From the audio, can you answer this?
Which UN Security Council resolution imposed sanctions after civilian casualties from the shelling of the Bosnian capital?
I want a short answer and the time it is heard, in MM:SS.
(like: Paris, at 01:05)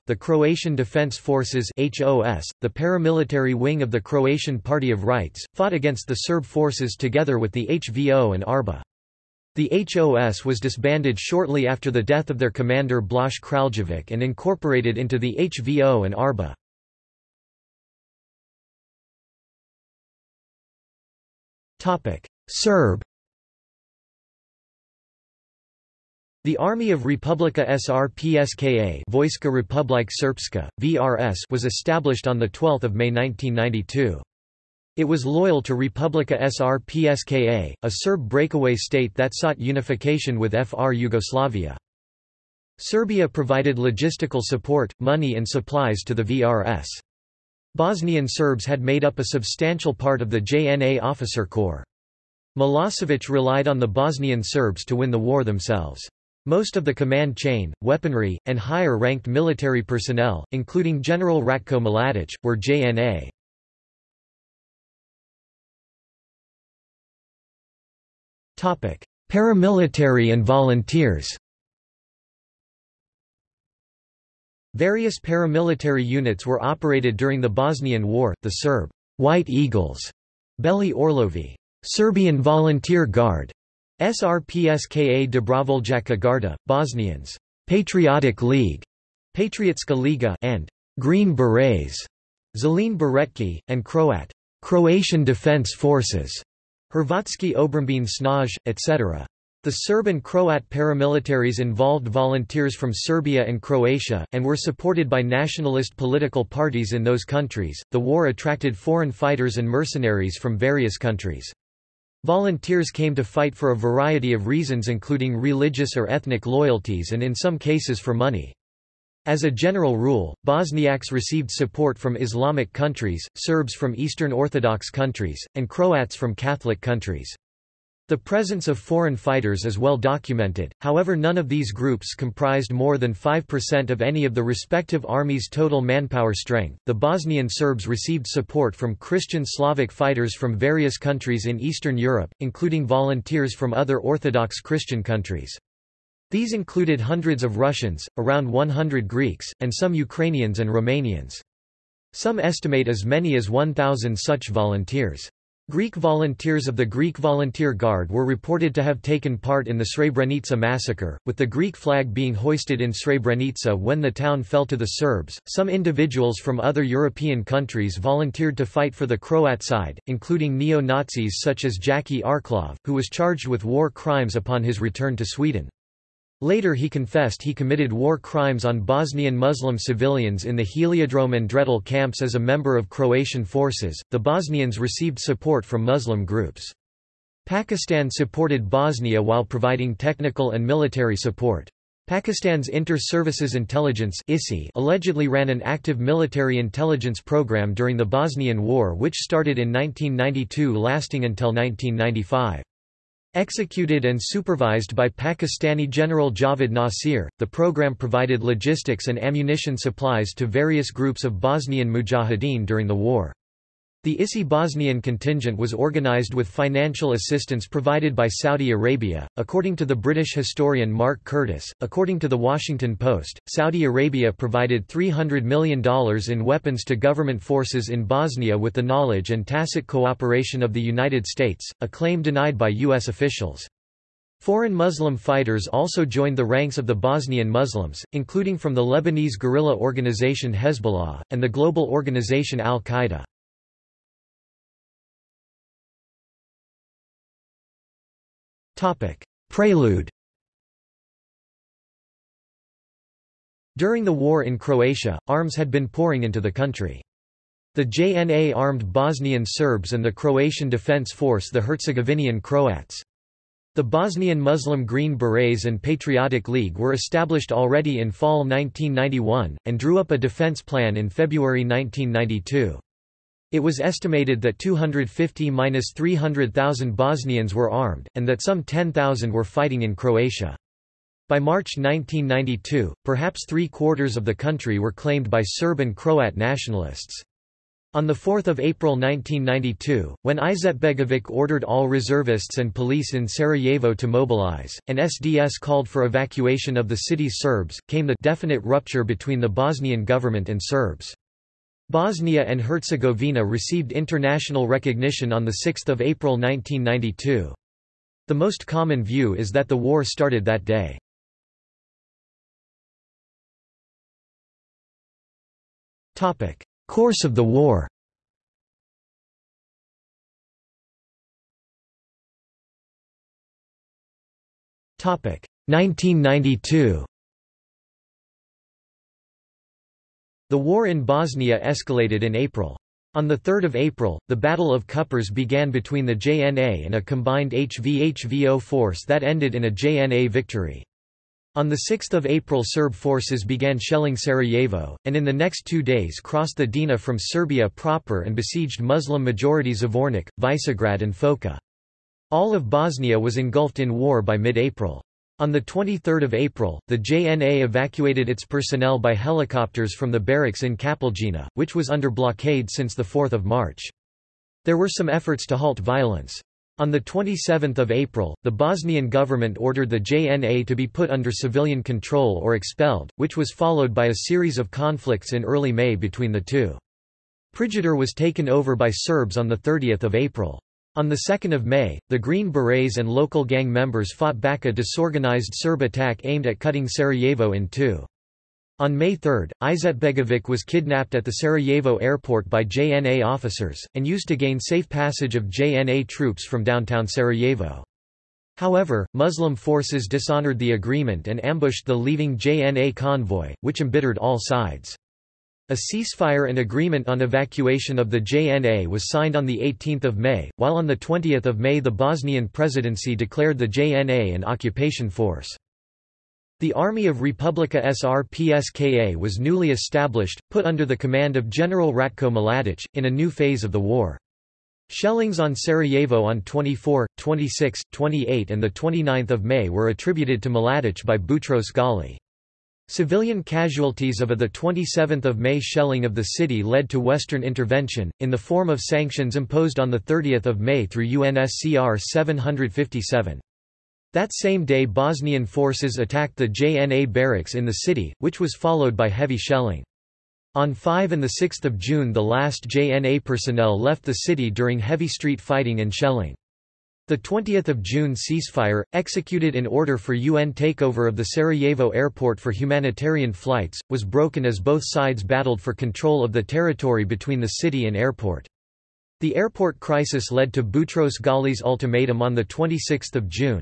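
UNSCR 757, at 07:21.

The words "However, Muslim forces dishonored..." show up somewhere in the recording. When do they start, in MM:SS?
06:38.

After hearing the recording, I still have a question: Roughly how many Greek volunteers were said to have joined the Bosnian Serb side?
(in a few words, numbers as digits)
around 100.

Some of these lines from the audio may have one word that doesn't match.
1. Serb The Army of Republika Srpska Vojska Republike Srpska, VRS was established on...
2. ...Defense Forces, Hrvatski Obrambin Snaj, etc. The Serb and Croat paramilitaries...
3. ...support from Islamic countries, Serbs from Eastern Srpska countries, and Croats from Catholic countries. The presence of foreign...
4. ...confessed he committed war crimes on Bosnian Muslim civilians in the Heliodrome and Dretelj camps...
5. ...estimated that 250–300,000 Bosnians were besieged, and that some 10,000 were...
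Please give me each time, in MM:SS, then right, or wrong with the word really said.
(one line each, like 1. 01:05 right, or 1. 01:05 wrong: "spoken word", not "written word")
1. 00:22 right
2. 01:35 right
3. 02:01 wrong: "Orthodox", not "Srpska"
4. 02:56 right
5. 04:33 wrong: "armed", not "besieged".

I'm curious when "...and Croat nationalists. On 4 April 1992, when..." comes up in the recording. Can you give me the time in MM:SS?
04:45.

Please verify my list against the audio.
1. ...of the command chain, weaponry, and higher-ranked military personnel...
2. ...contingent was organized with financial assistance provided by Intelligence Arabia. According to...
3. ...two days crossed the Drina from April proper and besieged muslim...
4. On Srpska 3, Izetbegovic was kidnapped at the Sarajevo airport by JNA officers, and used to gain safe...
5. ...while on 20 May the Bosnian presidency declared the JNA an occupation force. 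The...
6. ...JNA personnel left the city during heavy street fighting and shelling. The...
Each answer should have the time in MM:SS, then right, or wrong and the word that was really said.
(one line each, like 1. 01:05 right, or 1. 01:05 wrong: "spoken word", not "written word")
1. 00:56 right
2. 03:35 wrong: "Saudi", not "Intelligence"
3. 05:45 wrong: "Serbia", not "April"
4. 06:28 wrong: "May", not "Srpska"
5. 06:50 right
6. 07:32 right.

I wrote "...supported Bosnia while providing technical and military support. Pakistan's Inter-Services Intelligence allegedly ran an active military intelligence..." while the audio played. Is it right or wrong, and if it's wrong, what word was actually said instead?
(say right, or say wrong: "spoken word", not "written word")
right.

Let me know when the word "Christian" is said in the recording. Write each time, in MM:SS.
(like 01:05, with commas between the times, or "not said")
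02:18, 02:24.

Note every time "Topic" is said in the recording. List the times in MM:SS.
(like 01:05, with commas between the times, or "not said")
04:08, 05:24.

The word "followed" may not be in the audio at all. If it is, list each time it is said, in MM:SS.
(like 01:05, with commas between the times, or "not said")
06:13, 07:28.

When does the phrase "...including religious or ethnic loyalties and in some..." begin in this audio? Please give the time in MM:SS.
01:54.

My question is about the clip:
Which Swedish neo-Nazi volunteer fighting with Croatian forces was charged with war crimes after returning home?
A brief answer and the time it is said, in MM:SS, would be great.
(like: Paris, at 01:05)
Jackie Arklov, at 02:51.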